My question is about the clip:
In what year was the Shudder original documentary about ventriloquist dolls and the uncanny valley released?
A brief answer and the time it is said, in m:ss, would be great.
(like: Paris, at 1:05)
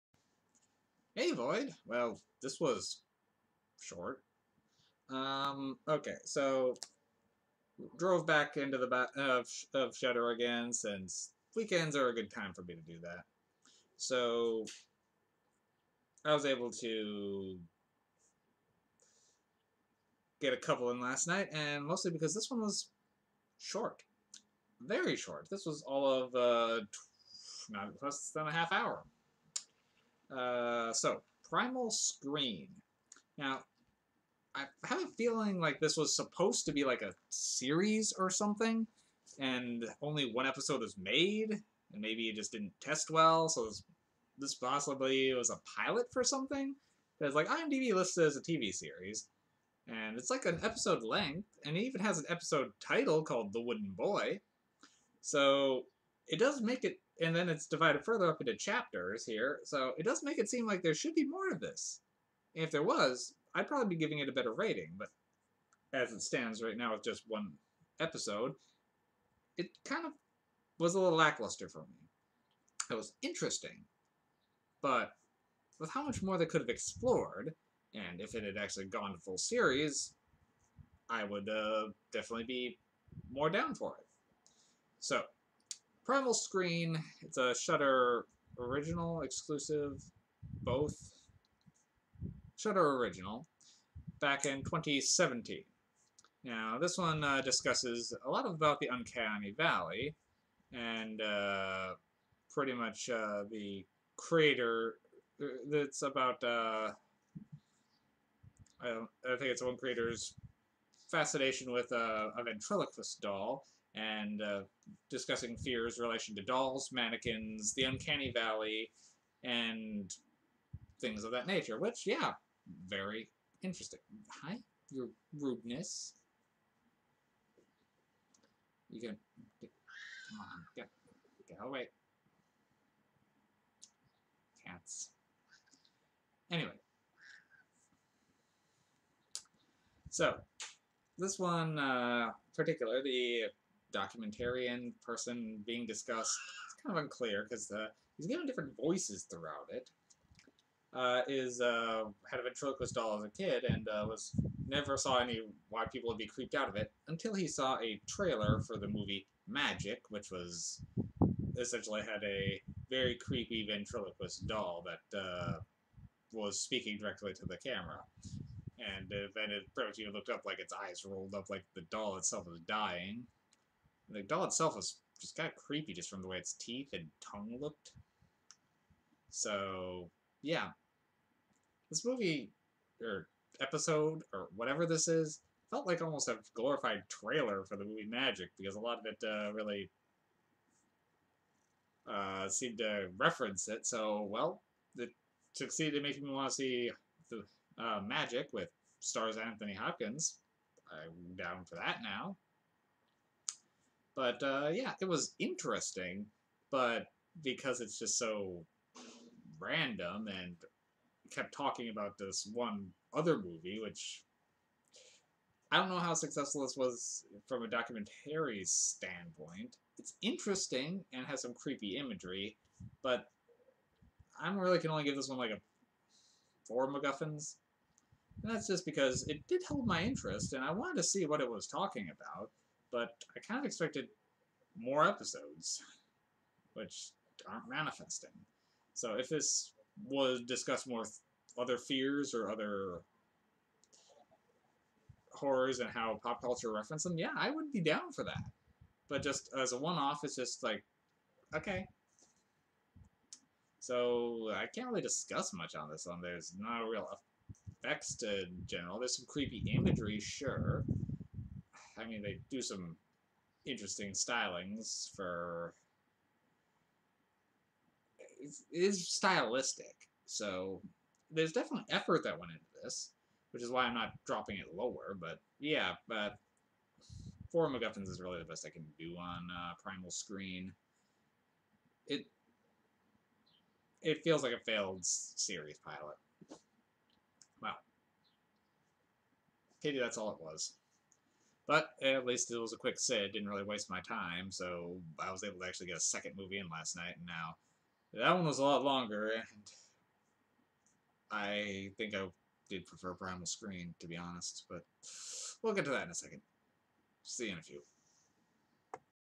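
2017, at 1:34.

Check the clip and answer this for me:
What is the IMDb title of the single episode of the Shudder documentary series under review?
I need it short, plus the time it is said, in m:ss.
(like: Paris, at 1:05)
The Wooden Boy, at 0:53.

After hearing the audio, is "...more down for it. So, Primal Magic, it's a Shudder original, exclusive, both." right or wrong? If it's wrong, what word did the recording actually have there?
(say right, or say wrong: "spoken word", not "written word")
wrong: "Screen", not "Magic".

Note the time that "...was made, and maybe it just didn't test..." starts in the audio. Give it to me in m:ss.
0:40.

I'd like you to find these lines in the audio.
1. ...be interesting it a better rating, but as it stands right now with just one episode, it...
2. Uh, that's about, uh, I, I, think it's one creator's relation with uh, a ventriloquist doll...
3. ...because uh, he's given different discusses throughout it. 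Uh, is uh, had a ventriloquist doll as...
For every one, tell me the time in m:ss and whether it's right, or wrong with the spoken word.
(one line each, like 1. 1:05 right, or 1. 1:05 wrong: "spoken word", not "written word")
1. 1:03 wrong: "giving", not "interesting"
2. 1:45 wrong: "fascination", not "relation"
3. 2:27 wrong: "voices", not "discusses".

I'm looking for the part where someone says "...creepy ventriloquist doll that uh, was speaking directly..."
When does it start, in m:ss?
2:43.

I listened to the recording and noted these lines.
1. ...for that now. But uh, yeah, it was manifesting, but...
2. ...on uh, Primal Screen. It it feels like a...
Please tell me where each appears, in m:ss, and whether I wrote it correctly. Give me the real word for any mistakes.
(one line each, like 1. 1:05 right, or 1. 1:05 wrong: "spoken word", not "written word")
1. 3:21 wrong: "interesting", not "manifesting"
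2. 4:39 right.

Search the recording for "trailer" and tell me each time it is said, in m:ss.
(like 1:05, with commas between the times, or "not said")
2:38, 3:07.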